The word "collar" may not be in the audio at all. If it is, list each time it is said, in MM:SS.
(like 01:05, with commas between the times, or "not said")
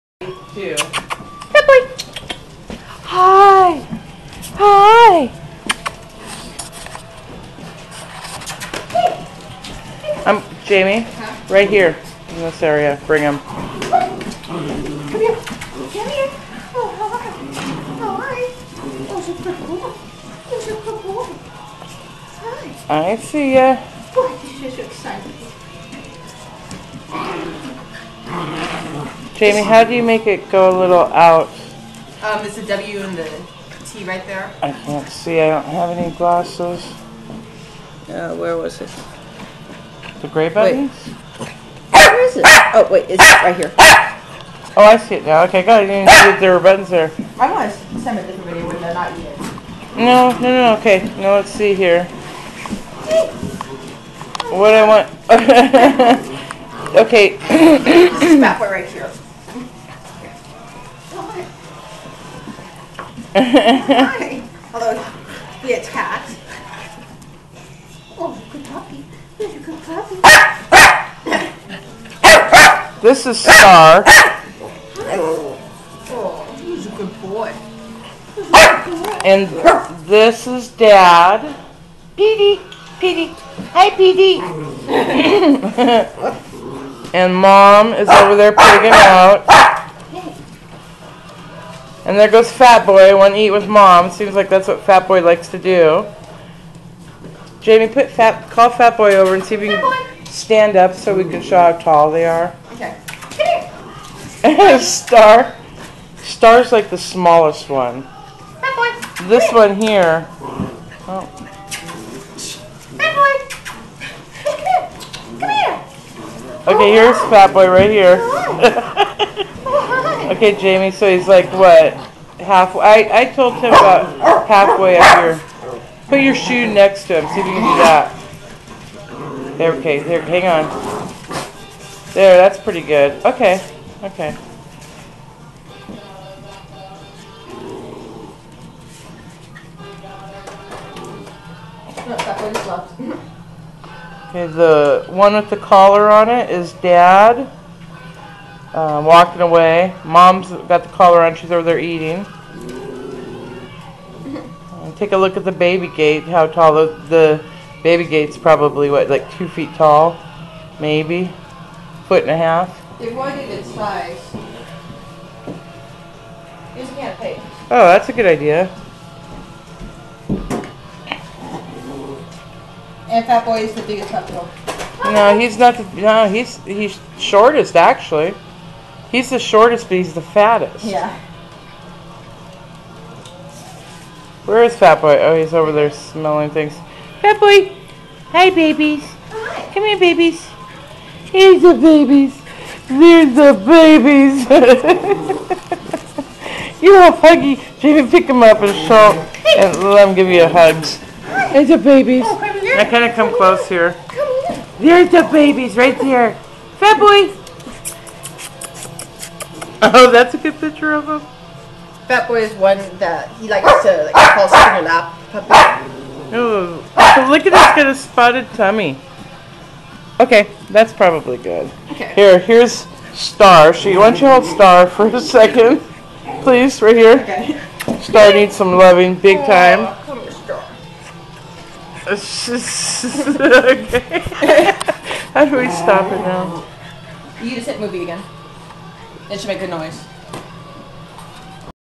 02:25, 02:30.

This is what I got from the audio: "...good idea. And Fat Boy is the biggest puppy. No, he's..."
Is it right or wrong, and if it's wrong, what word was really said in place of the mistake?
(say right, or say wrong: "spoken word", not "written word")
right.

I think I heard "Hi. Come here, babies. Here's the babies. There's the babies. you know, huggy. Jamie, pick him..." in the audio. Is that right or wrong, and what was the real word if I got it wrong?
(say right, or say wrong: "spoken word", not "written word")
right.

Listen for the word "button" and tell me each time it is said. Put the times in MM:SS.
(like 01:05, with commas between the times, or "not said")
00:40, 00:46.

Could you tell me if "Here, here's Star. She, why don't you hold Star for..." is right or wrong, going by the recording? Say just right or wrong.
right.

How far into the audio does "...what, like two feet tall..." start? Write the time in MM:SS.
02:38.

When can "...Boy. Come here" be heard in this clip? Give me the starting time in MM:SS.
01:53.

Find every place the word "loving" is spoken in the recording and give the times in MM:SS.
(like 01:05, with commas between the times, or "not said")
03:48.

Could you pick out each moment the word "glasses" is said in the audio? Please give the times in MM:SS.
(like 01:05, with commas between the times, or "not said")
00:36.